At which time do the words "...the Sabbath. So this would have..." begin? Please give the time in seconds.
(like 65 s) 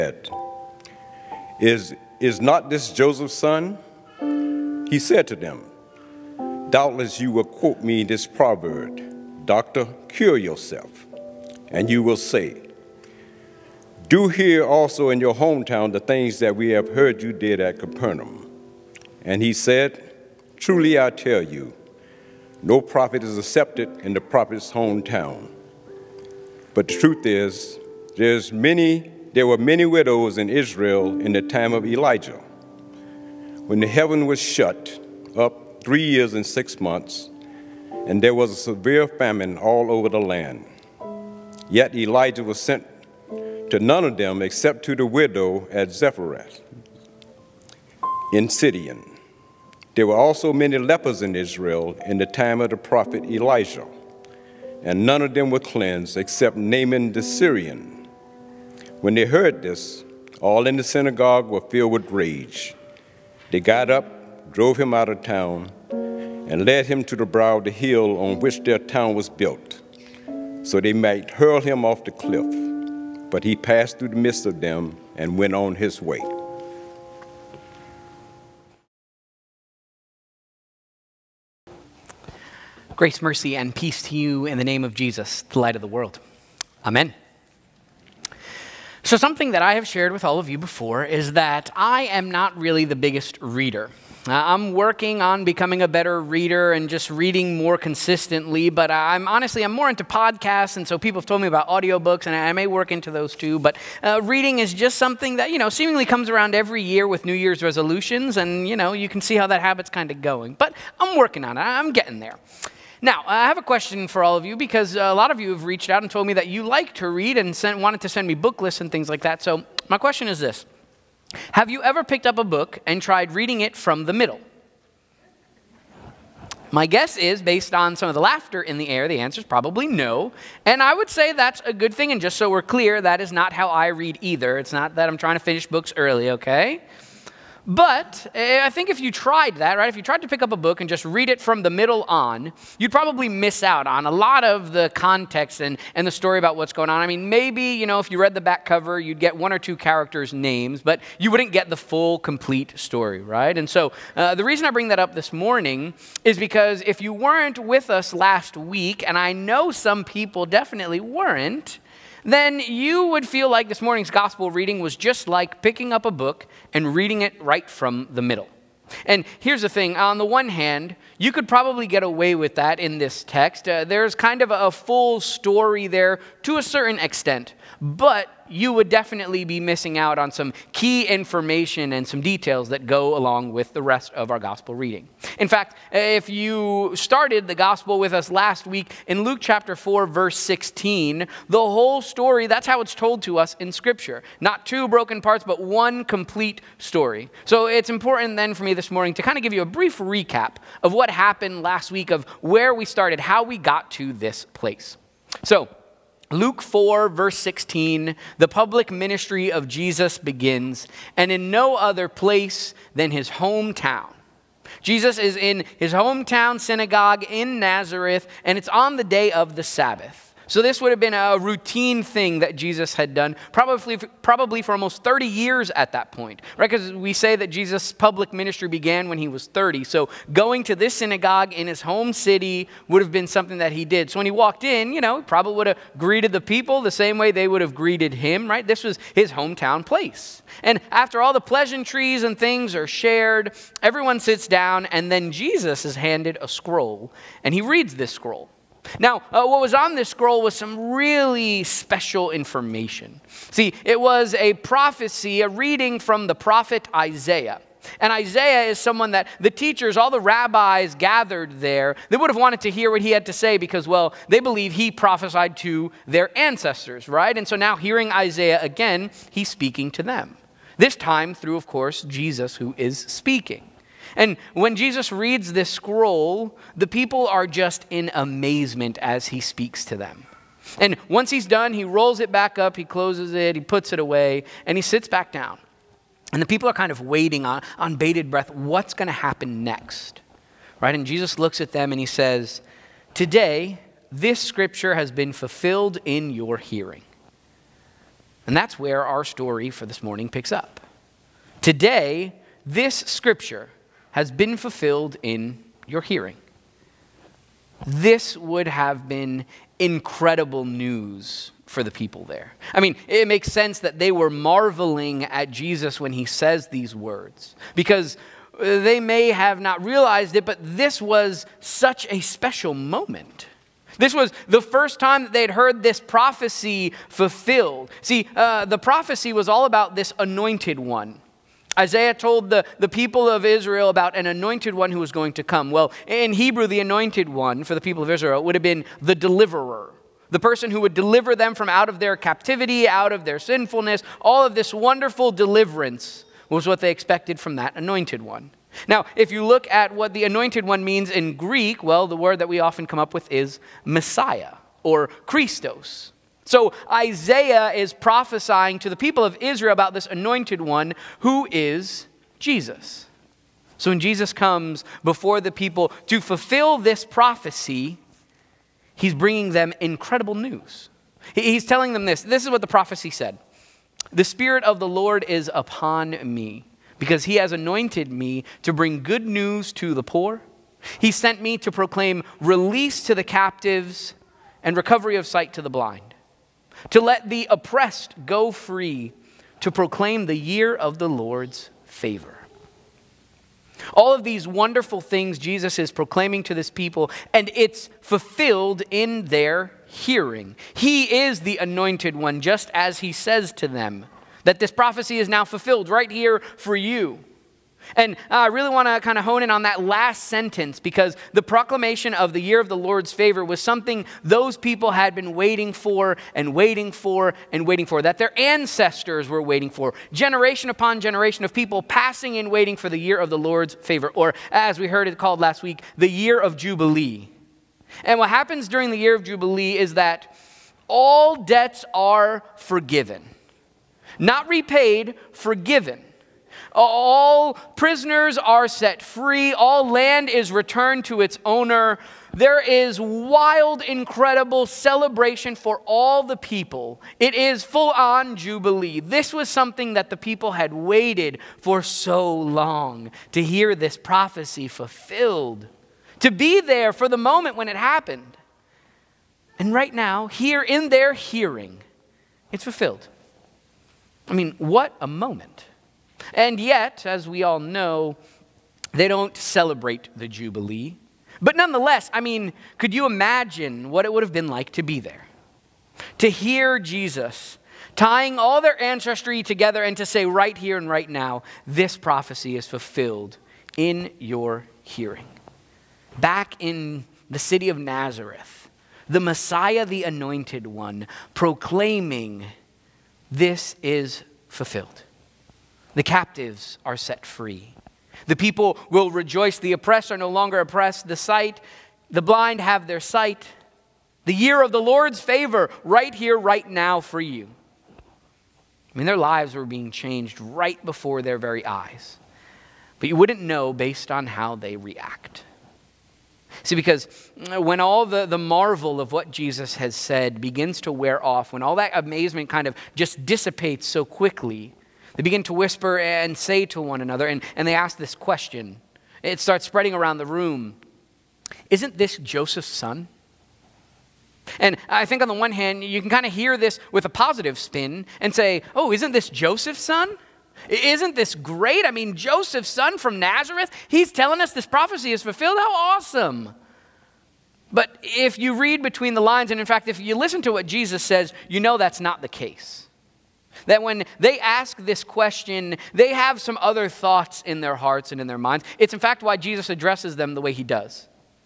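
219 s.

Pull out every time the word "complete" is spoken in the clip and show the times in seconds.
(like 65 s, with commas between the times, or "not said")
152 s, 196 s.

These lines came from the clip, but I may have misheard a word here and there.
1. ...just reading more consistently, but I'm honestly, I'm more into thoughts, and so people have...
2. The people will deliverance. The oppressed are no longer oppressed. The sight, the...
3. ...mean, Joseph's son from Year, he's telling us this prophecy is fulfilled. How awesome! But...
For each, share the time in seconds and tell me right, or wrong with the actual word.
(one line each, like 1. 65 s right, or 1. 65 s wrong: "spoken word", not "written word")
1. 96 s wrong: "podcasts", not "thoughts"
2. 498 s wrong: "rejoice", not "deliverance"
3. 541 s wrong: "Nazareth", not "Year".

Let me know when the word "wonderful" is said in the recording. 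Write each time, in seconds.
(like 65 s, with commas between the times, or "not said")
344 s, 394 s.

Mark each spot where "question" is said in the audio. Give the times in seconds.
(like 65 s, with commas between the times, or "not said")
113 s, 119 s, 528 s, 555 s.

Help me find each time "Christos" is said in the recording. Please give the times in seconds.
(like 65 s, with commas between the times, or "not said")
355 s.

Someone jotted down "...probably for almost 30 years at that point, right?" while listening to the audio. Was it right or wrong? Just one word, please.
right.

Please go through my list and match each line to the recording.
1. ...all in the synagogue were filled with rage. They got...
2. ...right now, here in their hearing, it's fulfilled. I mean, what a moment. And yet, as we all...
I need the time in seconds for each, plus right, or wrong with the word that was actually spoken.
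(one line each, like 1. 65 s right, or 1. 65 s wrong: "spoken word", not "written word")
1. 60 s right
2. 459 s right.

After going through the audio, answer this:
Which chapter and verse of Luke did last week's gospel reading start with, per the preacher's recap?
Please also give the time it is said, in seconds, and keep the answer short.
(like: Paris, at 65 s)
Luke 4:16, at 189 s.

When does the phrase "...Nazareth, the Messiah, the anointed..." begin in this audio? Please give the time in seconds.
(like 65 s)
487 s.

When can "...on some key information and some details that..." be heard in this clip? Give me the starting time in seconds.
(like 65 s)
180 s.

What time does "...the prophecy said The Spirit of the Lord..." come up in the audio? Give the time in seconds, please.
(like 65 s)
372 s.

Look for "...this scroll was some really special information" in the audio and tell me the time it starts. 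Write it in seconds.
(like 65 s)
249 s.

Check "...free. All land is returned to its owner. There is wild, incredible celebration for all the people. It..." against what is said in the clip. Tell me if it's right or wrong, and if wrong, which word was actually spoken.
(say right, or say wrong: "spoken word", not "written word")
right.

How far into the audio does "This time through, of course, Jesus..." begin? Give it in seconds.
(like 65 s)
270 s.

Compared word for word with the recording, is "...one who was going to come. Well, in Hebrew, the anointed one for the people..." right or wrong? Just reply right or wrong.
right.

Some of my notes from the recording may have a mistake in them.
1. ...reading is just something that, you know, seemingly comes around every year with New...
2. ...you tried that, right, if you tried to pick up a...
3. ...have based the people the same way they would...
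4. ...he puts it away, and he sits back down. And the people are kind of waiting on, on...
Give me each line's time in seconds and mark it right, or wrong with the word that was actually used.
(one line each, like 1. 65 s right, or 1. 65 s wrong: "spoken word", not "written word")
1. 104 s right
2. 138 s right
3. 235 s wrong: "greeted", not "based"
4. 283 s right.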